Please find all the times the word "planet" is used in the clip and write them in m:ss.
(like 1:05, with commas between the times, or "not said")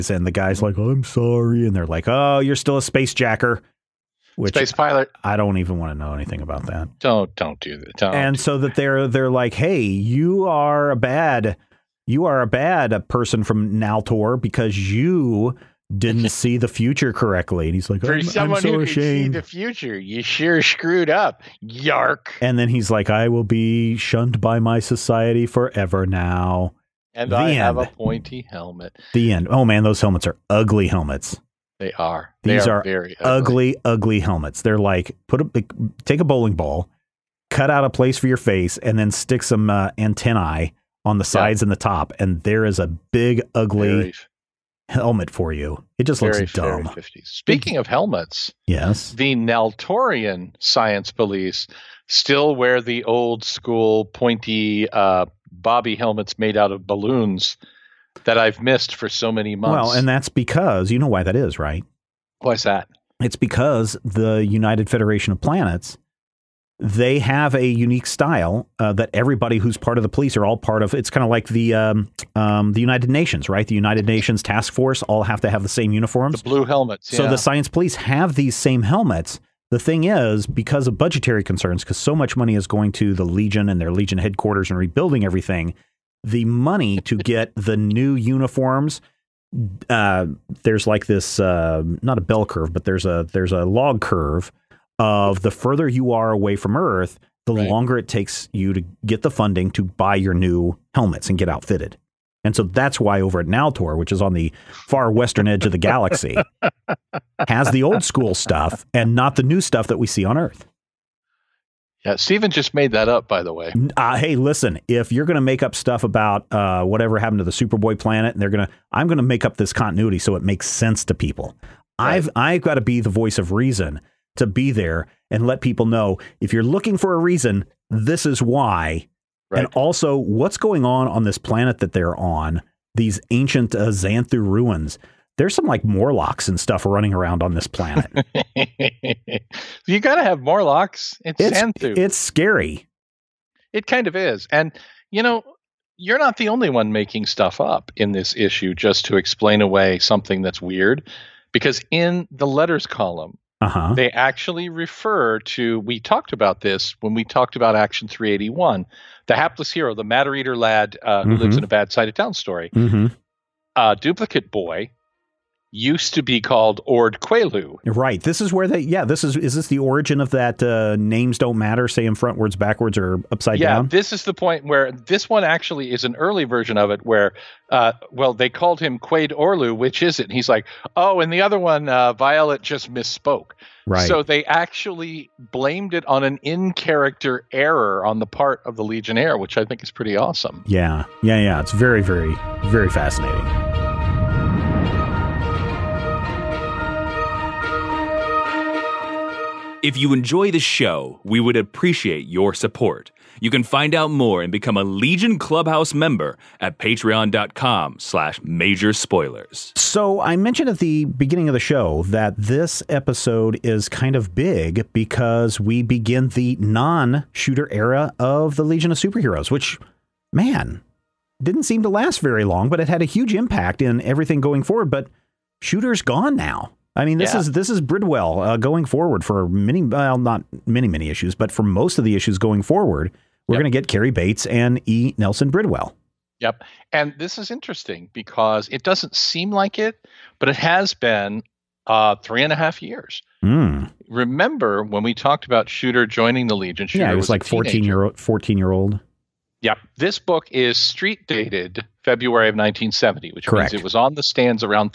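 1:05, 1:57, 2:11, 2:17.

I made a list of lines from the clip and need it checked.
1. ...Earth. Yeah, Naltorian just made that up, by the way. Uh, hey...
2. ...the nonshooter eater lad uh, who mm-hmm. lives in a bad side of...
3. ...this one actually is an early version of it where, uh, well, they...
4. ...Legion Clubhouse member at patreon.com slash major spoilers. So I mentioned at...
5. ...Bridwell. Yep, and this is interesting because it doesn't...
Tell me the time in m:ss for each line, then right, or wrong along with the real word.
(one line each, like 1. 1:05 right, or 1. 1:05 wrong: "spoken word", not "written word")
1. 1:50 wrong: "Steven", not "Naltorian"
2. 2:39 wrong: "matter", not "nonshooter"
3. 2:54 right
4. 3:24 right
5. 3:55 right.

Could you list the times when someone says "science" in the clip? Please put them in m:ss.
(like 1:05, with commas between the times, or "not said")
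0:50, 1:17.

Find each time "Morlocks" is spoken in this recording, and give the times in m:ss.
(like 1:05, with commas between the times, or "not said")
2:15, 2:20.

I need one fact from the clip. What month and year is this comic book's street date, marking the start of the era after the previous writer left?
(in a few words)
February 1970.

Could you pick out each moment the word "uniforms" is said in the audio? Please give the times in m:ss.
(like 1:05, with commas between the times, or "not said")
1:15, 1:28.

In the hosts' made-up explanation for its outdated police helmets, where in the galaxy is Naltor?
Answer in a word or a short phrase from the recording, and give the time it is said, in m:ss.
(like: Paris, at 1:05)
Far western edge, at 1:44.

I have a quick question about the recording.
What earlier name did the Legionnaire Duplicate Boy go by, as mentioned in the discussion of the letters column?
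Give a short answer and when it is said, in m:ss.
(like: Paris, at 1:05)
Ord Quelu, at 2:46.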